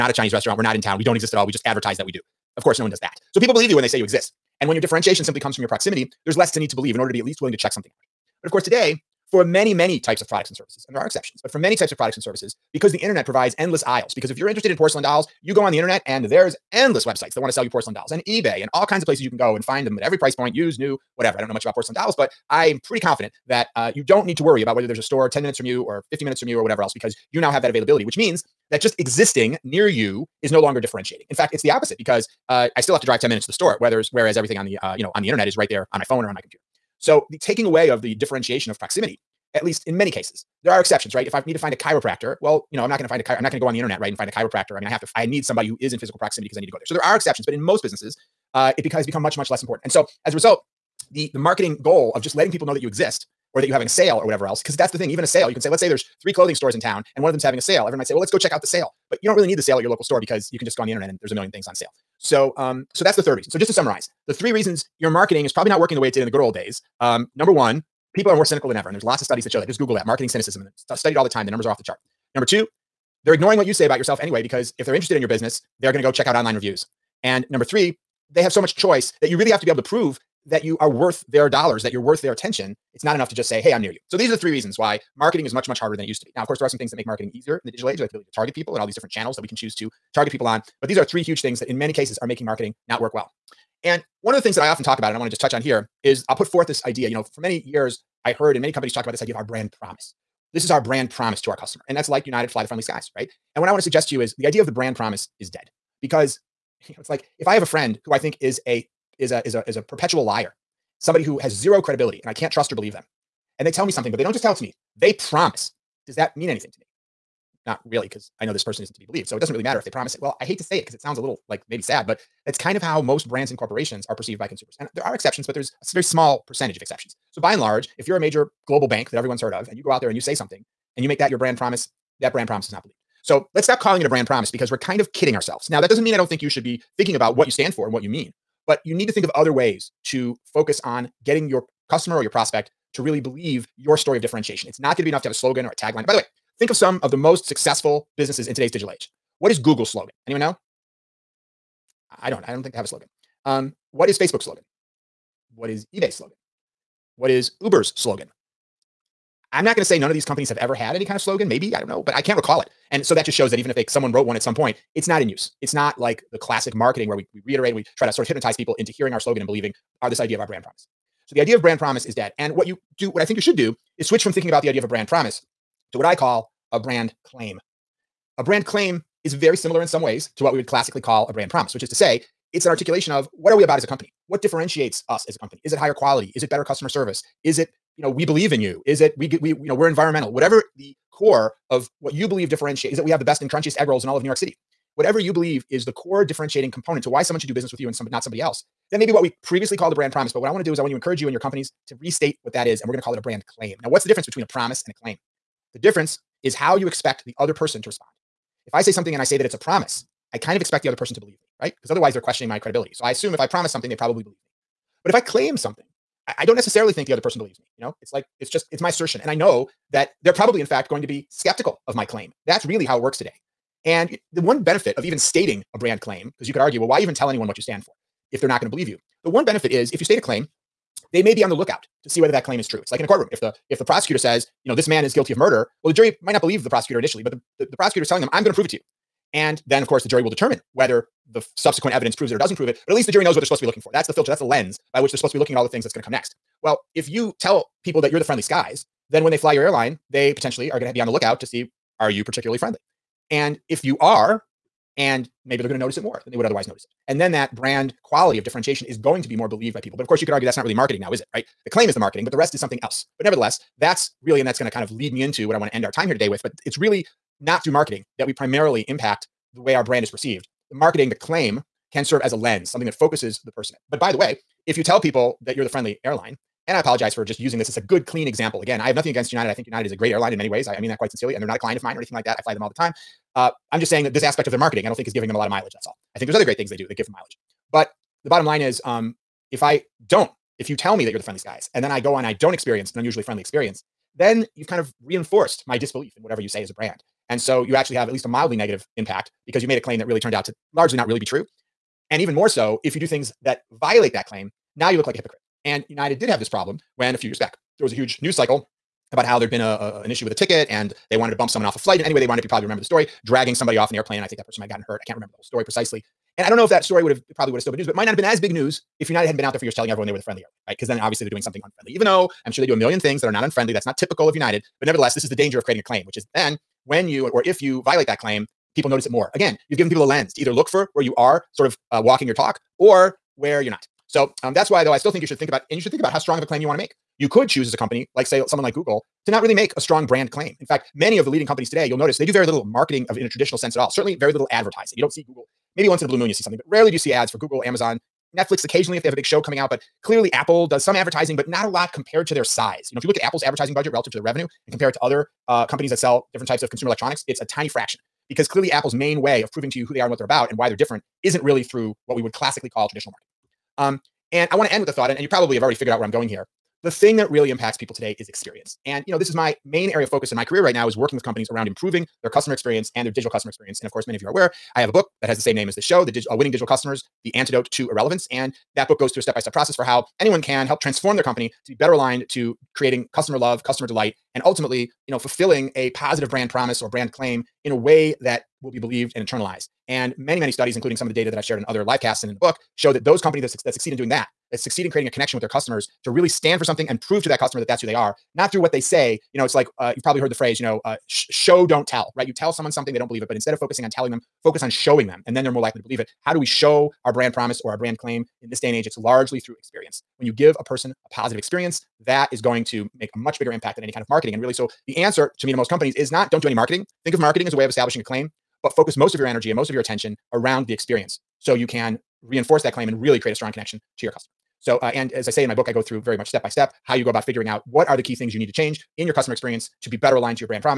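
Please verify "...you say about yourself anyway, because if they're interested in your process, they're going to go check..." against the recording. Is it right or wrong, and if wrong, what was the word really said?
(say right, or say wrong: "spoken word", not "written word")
wrong: "business", not "process".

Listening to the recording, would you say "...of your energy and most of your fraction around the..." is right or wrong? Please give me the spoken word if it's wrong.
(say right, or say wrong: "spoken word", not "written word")
wrong: "attention", not "fraction".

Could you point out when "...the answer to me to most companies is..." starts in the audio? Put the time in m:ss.
6:54.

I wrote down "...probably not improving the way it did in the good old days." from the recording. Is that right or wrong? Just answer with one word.
wrong.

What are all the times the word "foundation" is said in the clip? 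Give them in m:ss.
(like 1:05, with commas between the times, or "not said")
not said.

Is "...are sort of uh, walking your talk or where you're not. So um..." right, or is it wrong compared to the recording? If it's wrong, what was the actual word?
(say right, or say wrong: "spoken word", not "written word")
right.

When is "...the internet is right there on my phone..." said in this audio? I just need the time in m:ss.
0:35.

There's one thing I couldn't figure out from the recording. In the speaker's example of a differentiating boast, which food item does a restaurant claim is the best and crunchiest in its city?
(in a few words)
Egg rolls.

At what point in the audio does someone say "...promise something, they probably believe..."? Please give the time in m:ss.
3:33.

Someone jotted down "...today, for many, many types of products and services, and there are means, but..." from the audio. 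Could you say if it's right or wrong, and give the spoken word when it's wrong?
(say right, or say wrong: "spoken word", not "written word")
wrong: "exceptions", not "means".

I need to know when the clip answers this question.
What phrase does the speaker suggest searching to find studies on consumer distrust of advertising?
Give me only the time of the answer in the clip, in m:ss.
1:10.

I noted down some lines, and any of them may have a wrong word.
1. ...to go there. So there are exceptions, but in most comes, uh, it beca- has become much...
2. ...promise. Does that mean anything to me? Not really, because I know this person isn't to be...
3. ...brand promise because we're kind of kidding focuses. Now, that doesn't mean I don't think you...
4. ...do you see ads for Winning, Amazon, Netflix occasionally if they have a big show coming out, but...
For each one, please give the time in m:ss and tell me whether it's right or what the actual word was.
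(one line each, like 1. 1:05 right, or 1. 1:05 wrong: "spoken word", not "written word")
1. 0:46 wrong: "businesses", not "comes"
2. 1:55 right
3. 2:14 wrong: "ourselves", not "focuses"
4. 5:46 wrong: "Google", not "Winning".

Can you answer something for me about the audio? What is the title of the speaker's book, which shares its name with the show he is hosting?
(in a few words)
Winning Digital Customers.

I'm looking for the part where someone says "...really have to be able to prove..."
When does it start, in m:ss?
1:19.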